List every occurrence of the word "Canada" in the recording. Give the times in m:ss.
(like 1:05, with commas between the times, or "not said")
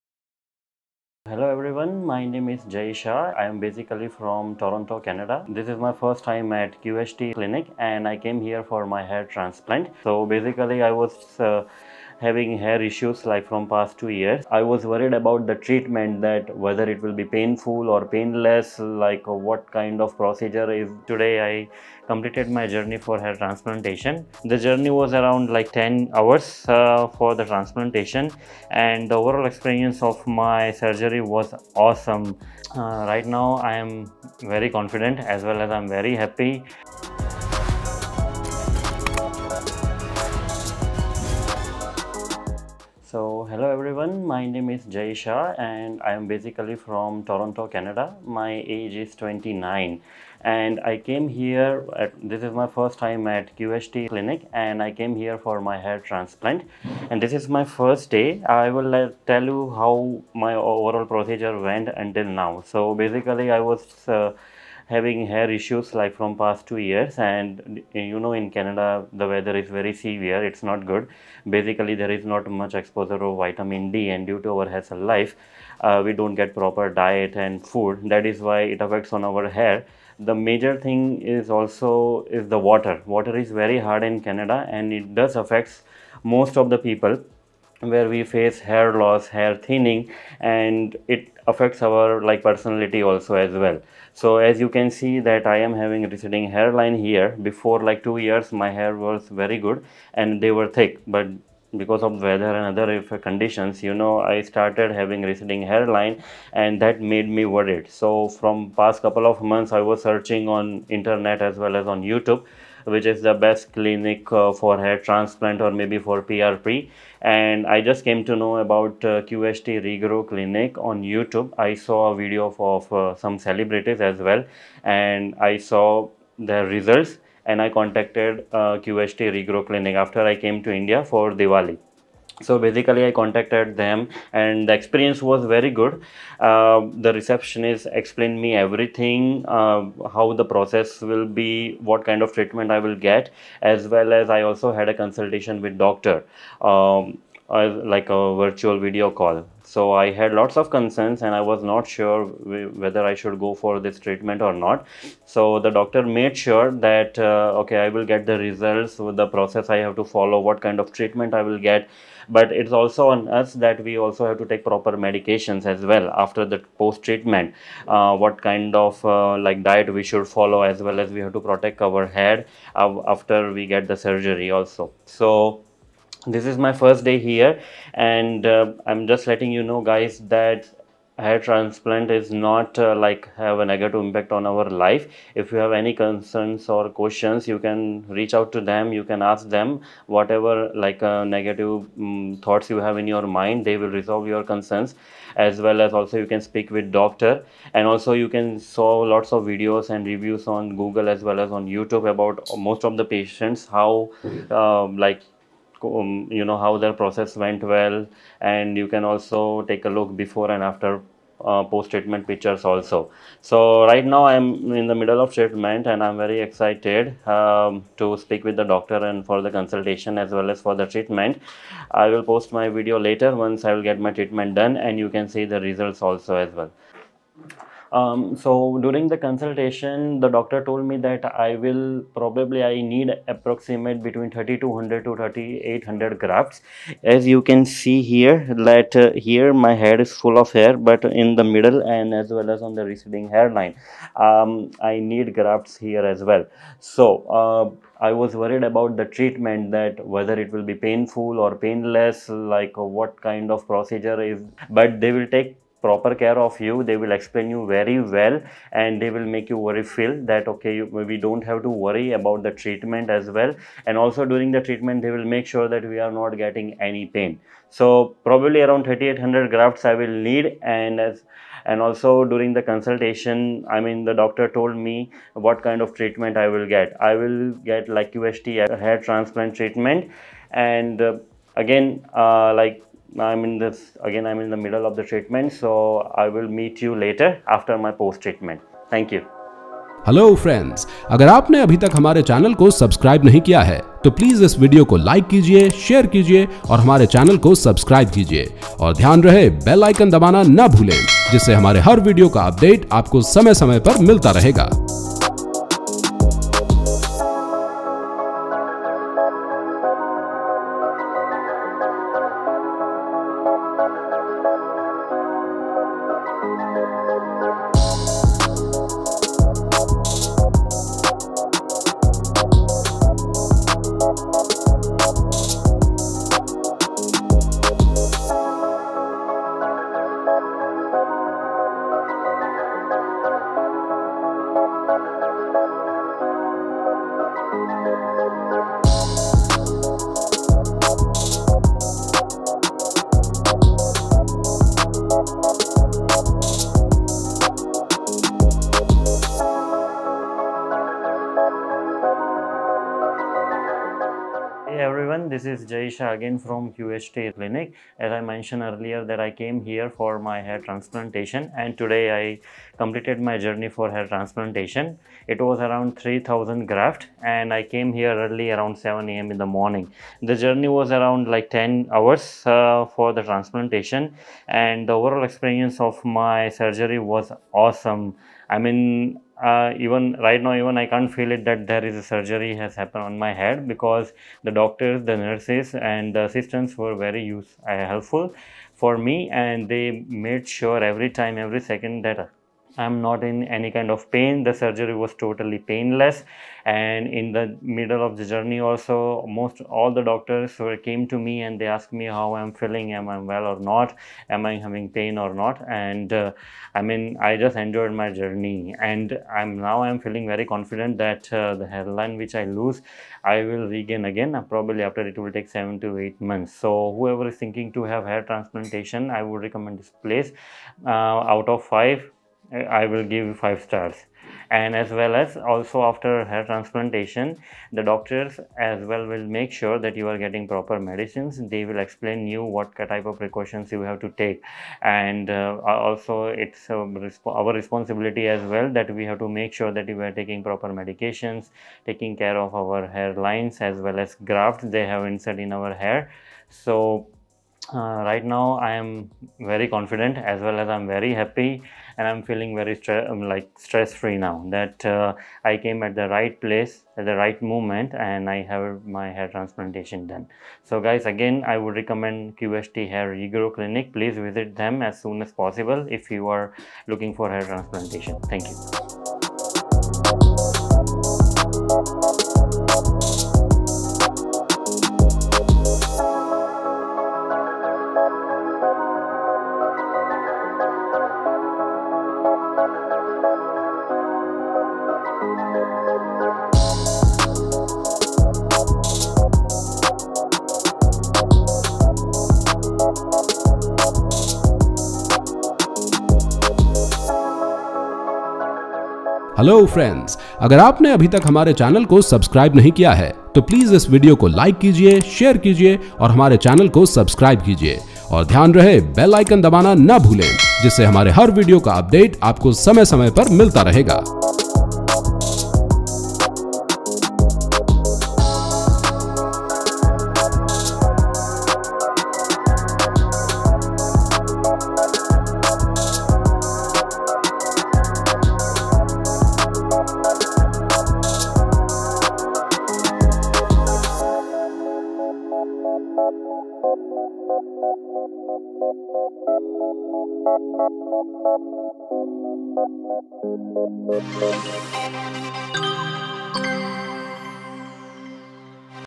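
0:04, 0:47, 1:08, 1:24.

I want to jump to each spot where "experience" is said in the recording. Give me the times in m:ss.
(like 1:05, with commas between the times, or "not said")
0:29, 2:14, 6:15.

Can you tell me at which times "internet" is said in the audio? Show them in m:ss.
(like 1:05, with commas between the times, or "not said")
1:50.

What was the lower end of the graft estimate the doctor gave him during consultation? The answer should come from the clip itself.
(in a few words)
3200.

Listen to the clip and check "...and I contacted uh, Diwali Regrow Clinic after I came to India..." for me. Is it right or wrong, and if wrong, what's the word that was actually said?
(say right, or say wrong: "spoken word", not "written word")
wrong: "QHT", not "Diwali".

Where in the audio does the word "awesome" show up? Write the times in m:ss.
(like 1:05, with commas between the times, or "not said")
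0:31, 6:17.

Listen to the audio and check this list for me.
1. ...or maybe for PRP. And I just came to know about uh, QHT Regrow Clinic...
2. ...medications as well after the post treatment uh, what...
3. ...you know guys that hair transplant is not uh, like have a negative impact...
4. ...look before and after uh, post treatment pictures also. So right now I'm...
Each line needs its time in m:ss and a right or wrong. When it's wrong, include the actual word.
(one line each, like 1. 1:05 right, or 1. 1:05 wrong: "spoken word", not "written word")
1. 1:55 right
2. 2:44 right
3. 2:59 right
4. 3:29 right.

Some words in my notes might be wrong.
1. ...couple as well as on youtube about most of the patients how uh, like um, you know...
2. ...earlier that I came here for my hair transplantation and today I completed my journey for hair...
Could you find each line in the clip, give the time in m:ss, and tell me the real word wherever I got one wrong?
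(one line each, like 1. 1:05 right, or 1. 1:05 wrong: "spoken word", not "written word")
1. 3:20 wrong: "google", not "couple"
2. 5:58 right.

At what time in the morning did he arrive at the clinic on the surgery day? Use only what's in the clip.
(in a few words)
7 a.m.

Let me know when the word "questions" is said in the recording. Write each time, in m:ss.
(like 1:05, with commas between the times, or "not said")
3:06.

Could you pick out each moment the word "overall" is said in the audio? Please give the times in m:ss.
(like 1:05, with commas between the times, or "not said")
0:29, 1:00, 6:14.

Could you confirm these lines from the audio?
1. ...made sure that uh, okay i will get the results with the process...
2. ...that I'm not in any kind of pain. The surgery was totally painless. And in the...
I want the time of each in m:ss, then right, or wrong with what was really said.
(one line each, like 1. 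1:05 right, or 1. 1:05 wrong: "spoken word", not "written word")
1. 2:36 right
2. 6:32 right.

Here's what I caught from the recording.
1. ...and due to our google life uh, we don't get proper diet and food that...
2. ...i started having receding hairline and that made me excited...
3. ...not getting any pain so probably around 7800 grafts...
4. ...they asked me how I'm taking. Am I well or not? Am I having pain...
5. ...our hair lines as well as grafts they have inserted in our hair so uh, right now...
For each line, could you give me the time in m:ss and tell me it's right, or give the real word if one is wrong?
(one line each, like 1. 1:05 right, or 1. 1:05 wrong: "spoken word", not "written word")
1. 1:14 wrong: "hassle", not "google"
2. 1:44 wrong: "worried", not "excited"
3. 4:26 wrong: "3800", not "7800"
4. 6:41 wrong: "feeling", not "taking"
5. 7:22 right.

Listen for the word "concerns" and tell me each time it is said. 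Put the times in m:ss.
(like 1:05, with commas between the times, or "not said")
2:30, 3:05, 3:14.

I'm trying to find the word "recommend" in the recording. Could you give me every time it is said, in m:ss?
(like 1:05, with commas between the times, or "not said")
6:59, 7:41.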